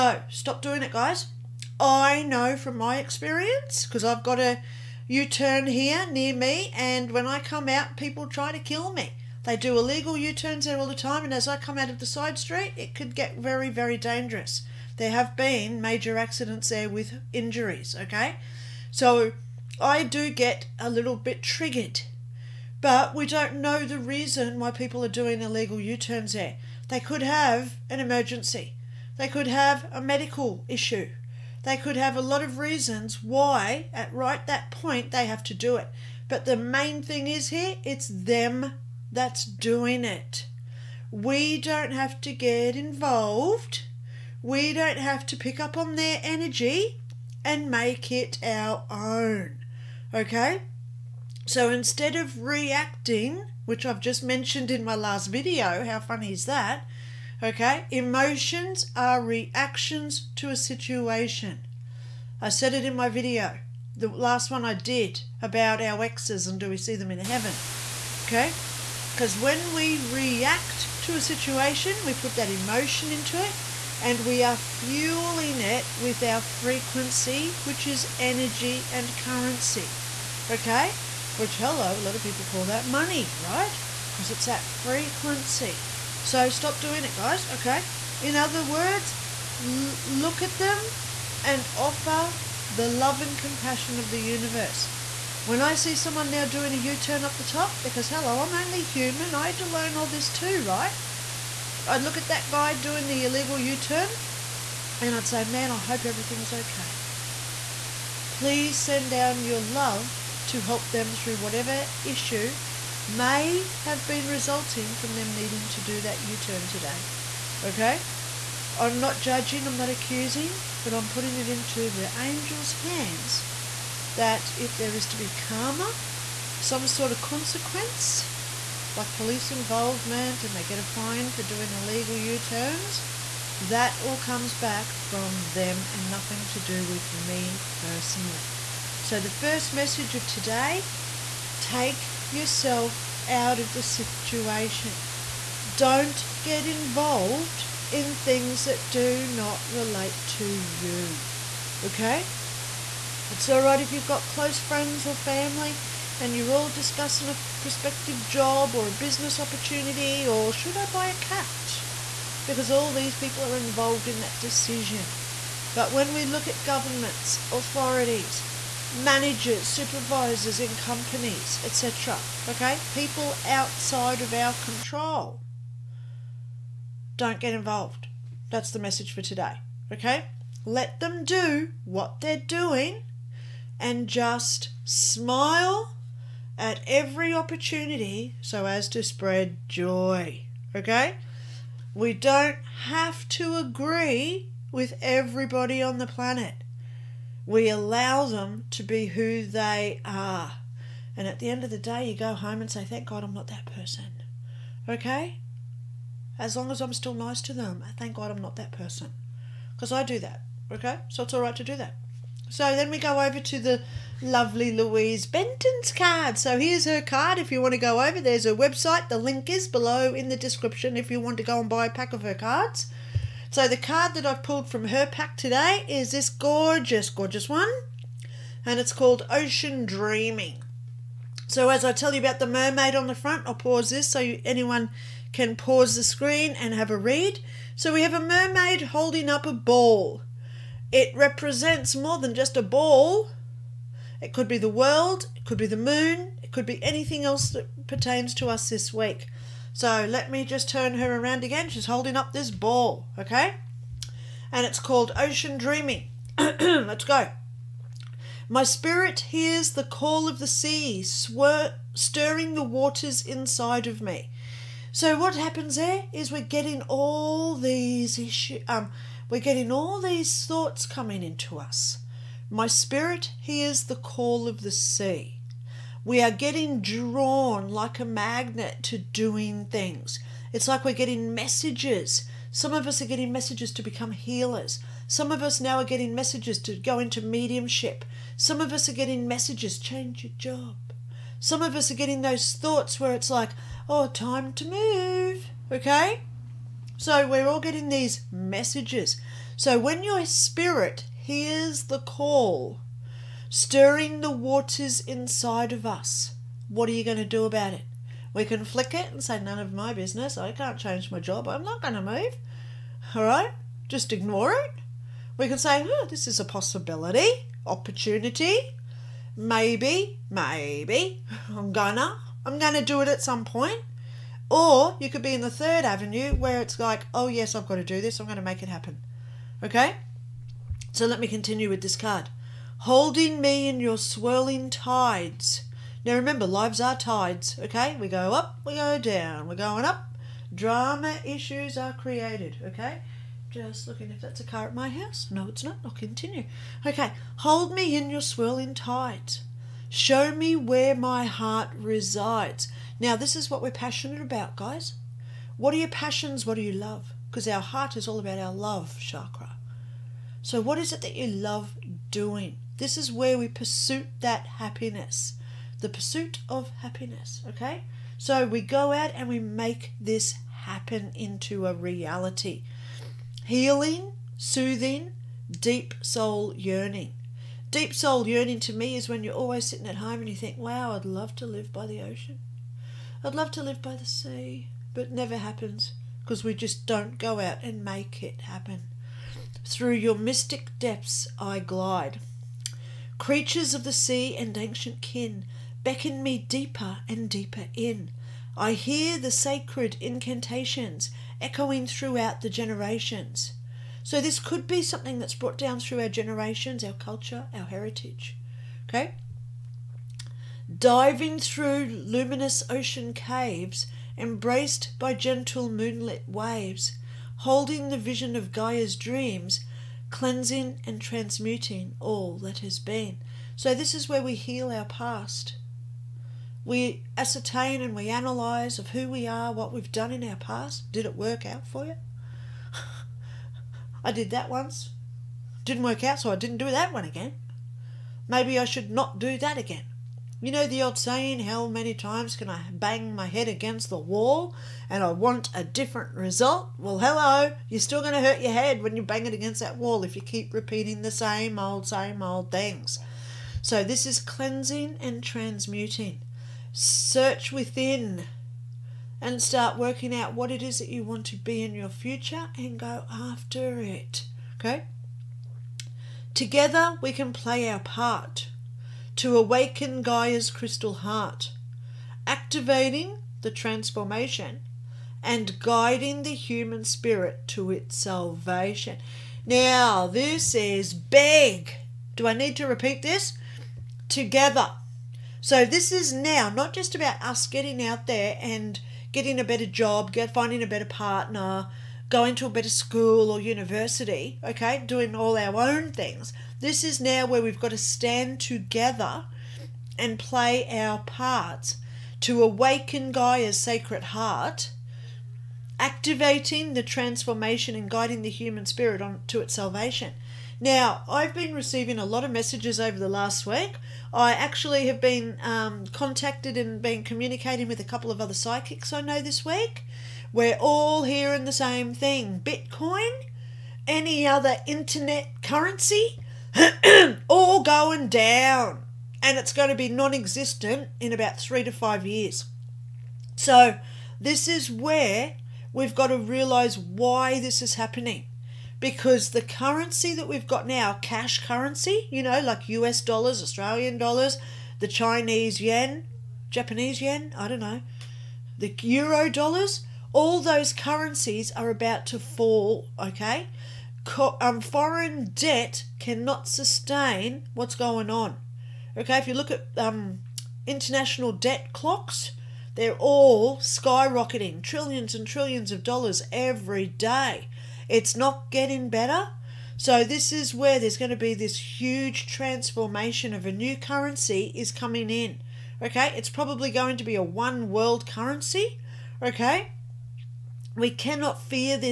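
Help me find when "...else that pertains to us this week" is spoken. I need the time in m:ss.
4:07.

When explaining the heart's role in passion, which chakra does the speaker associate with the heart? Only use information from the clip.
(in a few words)
Love chakra.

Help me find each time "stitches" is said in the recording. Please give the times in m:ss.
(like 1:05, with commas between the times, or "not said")
not said.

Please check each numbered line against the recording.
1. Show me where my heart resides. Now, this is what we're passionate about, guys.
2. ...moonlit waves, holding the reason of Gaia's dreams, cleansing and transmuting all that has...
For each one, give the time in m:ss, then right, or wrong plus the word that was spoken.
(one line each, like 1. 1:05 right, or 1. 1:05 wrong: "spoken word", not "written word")
1. 5:49 right
2. 6:55 wrong: "vision", not "reason".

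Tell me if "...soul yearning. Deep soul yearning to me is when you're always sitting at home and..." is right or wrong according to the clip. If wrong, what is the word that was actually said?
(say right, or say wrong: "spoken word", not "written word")
right.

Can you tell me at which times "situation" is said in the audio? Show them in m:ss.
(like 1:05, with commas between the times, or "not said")
1:00, 1:11, 2:23.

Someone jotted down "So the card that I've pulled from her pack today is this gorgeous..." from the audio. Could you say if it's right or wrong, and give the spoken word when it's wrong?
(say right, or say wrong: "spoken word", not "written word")
right.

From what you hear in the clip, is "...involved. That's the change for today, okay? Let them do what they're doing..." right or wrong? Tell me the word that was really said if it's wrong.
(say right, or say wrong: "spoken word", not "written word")
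wrong: "message", not "change".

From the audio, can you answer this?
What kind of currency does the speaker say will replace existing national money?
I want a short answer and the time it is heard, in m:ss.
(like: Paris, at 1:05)
One world currency, at 9:37.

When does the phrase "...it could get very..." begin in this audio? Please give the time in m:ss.
0:12.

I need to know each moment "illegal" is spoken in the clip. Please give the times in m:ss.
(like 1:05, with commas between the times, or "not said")
0:09, 0:25, 1:43, 2:11.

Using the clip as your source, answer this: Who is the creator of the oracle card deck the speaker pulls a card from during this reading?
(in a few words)
Louise Benton.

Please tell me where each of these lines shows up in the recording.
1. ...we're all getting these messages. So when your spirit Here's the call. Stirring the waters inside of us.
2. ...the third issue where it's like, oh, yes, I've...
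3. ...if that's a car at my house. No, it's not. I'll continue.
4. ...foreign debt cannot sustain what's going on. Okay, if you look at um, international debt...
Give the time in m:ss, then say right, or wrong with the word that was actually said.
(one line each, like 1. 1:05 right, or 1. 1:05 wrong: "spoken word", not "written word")
1. 4:57 right
2. 5:25 wrong: "avenue", not "issue"
3. 5:44 right
4. 9:14 right.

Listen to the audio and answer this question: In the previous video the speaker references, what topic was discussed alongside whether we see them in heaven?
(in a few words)
Our exes.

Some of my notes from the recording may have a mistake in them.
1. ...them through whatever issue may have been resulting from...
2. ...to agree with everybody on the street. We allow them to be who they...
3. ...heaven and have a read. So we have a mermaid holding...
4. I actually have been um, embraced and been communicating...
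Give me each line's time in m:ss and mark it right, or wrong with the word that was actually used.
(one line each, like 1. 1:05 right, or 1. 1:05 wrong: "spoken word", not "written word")
1. 1:50 right
2. 3:13 wrong: "planet", not "street"
3. 3:56 wrong: "screen", not "heaven"
4. 8:34 wrong: "contacted", not "embraced".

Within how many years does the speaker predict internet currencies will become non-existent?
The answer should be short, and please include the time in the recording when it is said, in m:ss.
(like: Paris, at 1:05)
3 to 5 years, at 8:51.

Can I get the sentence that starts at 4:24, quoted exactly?
So what happens there is we're getting all these issue, um, we're getting all these thoughts coming into us.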